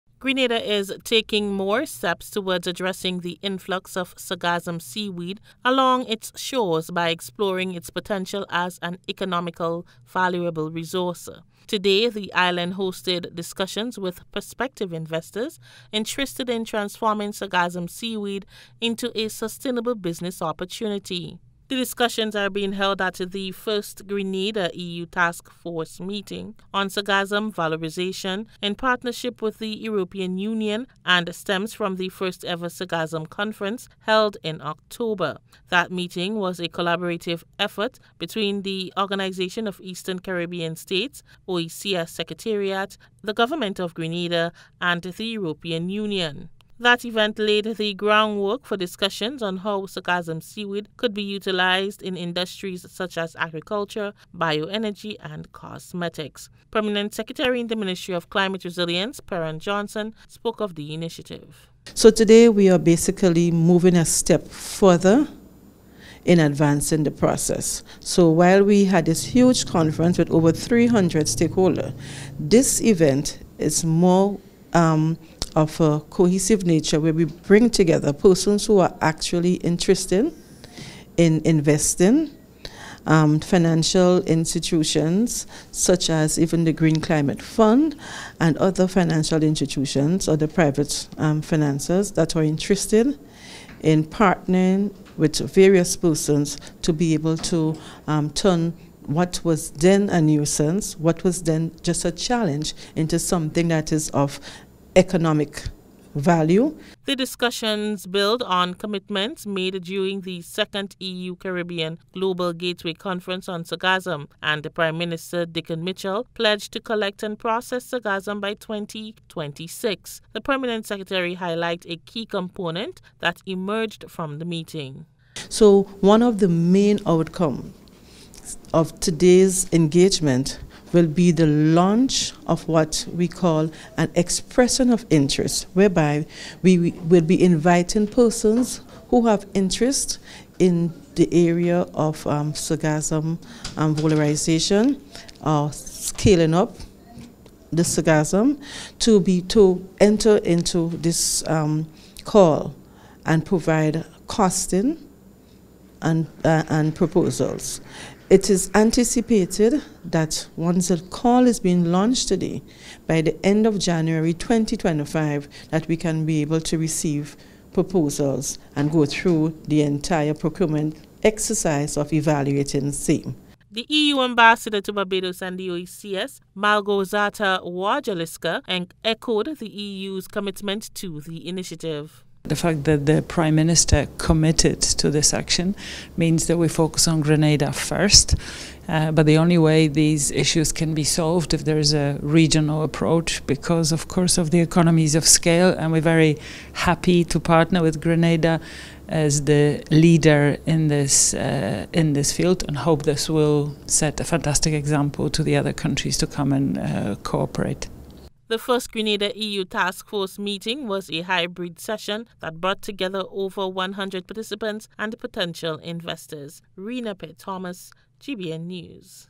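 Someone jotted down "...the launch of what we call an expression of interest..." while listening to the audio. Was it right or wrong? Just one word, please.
right.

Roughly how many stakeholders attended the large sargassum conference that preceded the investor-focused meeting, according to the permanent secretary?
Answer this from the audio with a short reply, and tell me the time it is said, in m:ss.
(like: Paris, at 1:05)
over 300, at 1:10.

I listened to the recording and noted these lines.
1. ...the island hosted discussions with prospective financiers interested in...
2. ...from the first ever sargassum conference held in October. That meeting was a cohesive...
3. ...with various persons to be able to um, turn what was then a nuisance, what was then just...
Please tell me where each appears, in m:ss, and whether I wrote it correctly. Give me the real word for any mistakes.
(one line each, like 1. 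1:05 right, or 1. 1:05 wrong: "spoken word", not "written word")
1. 0:12 wrong: "investors", not "financiers"
2. 0:31 wrong: "collaborative", not "cohesive"
3. 1:35 right.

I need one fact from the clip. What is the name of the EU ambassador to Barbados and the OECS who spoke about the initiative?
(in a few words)
Malgorzata Wasilewska.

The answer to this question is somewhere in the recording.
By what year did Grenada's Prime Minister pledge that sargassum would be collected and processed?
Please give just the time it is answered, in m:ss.
1:58.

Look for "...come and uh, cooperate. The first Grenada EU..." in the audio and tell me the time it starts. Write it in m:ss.
3:26.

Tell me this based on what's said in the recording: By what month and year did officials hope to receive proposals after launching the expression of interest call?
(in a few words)
January 2025.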